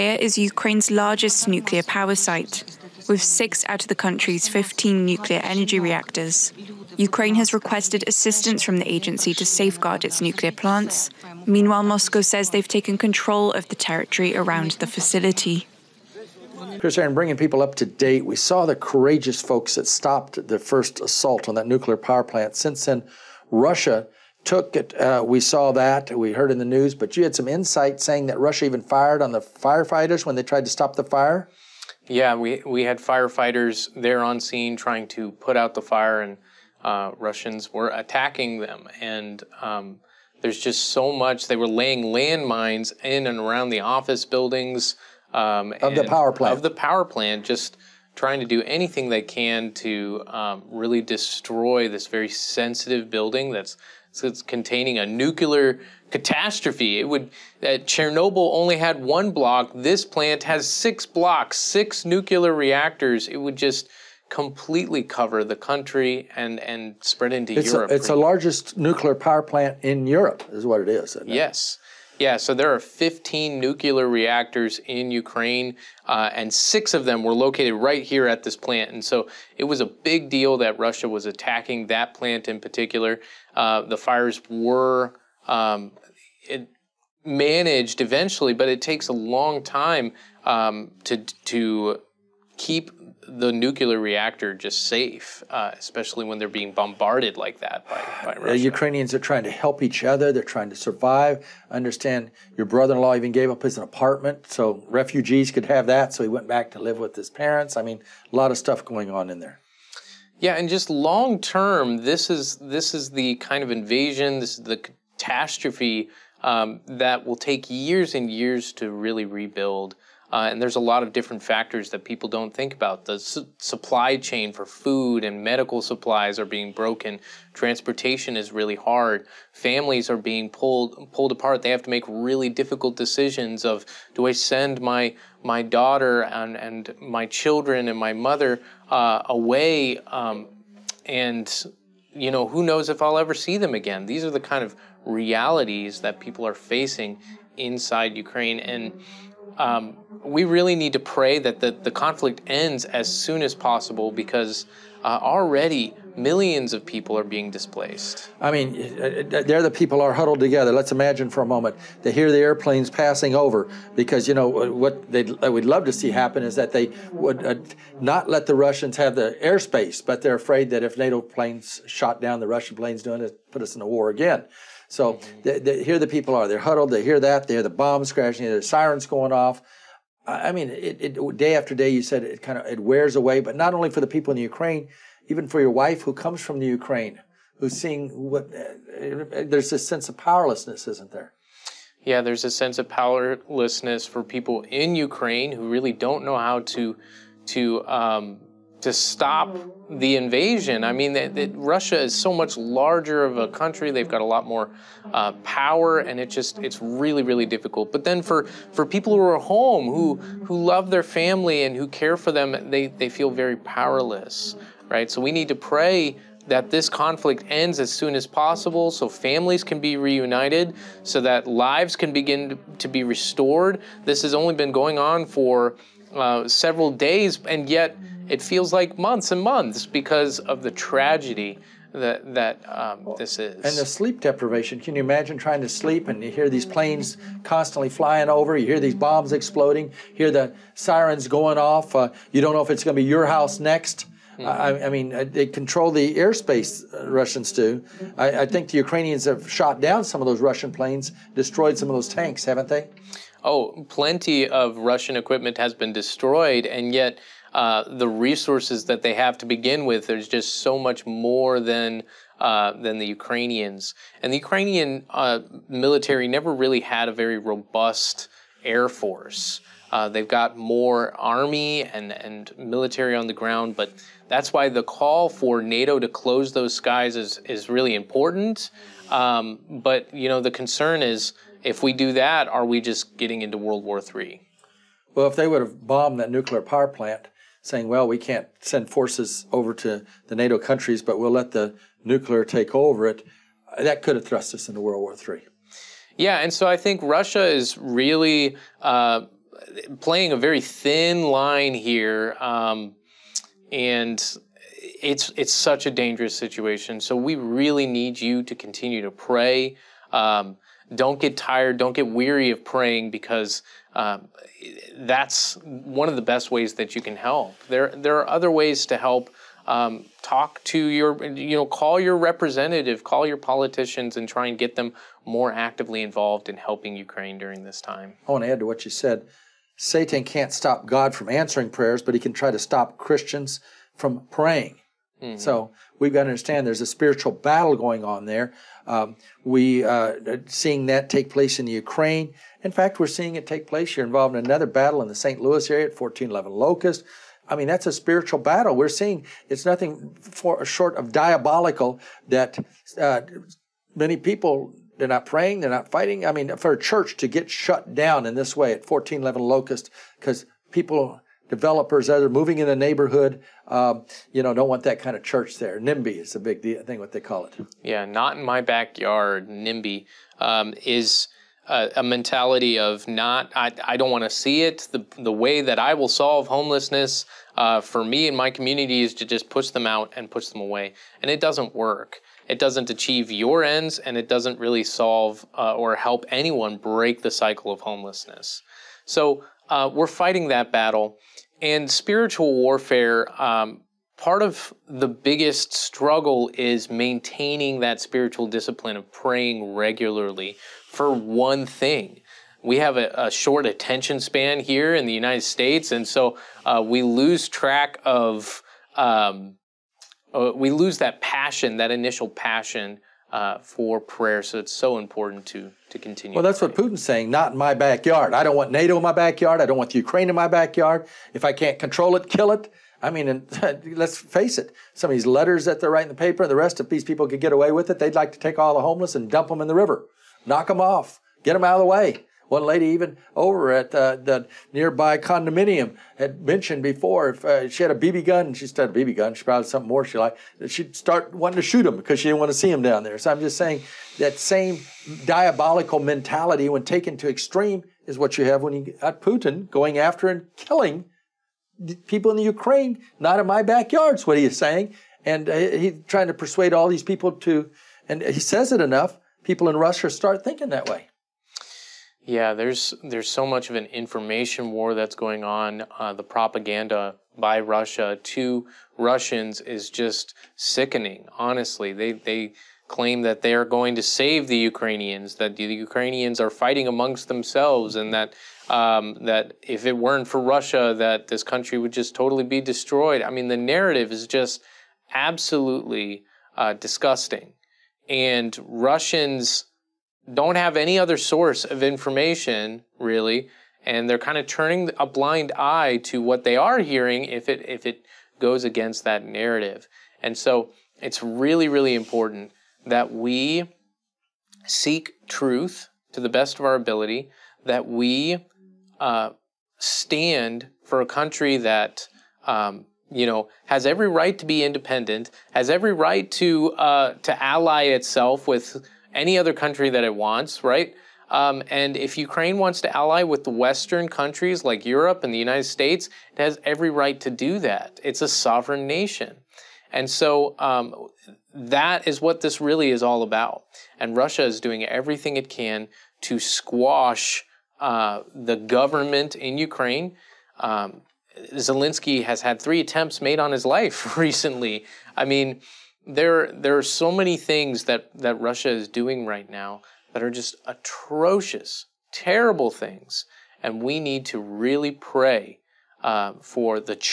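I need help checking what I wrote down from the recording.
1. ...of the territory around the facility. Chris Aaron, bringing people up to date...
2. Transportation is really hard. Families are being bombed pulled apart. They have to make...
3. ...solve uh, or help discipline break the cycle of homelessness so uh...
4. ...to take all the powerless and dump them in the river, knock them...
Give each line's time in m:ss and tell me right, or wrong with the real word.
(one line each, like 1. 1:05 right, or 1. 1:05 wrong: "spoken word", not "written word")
1. 0:13 right
2. 2:07 wrong: "pulled", not "bombed"
3. 6:24 wrong: "anyone", not "discipline"
4. 7:08 wrong: "homeless", not "powerless".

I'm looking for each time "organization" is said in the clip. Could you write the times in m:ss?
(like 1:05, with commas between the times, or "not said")
not said.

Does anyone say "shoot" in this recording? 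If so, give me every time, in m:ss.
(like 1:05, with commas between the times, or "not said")
7:21.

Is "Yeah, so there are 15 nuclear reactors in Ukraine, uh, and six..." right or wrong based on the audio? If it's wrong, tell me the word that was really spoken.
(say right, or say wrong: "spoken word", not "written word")
right.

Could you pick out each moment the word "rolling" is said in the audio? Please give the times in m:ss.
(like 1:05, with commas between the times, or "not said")
not said.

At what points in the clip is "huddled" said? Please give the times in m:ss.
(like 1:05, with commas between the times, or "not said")
2:40, 2:56.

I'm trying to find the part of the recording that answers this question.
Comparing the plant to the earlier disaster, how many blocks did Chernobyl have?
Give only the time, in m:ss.
0:57.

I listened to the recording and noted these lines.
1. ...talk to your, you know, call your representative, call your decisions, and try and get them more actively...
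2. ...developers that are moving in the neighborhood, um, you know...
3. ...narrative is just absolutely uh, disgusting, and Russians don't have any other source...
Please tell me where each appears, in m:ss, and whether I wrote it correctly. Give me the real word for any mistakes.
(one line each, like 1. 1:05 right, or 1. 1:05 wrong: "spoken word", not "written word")
1. 5:20 wrong: "politicians", not "decisions"
2. 6:01 right
3. 8:03 right.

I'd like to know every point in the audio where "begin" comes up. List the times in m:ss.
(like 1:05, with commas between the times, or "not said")
3:42, 4:19.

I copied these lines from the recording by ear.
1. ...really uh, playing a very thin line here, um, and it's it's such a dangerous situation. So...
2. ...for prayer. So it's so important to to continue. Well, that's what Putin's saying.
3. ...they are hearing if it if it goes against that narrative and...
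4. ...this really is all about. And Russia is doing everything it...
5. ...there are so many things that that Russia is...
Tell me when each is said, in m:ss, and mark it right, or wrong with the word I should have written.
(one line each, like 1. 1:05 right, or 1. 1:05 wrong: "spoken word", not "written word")
1. 4:57 right
2. 6:53 right
3. 8:16 right
4. 8:52 right
5. 9:06 right.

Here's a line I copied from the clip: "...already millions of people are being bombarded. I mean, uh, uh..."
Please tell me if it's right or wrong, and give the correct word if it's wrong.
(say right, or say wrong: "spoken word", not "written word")
wrong: "displaced", not "bombarded".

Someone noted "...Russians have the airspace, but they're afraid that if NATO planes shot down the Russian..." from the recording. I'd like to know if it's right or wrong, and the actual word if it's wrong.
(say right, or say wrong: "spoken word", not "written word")
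right.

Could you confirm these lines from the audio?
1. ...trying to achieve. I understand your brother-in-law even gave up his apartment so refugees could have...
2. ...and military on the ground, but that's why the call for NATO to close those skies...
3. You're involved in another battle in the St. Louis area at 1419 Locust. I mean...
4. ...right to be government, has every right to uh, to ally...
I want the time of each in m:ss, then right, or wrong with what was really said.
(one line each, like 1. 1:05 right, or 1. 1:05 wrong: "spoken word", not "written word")
1. 1:40 wrong: "survive", not "achieve"
2. 4:32 right
3. 5:43 wrong: "1411", not "1419"
4. 8:34 wrong: "independent", not "government".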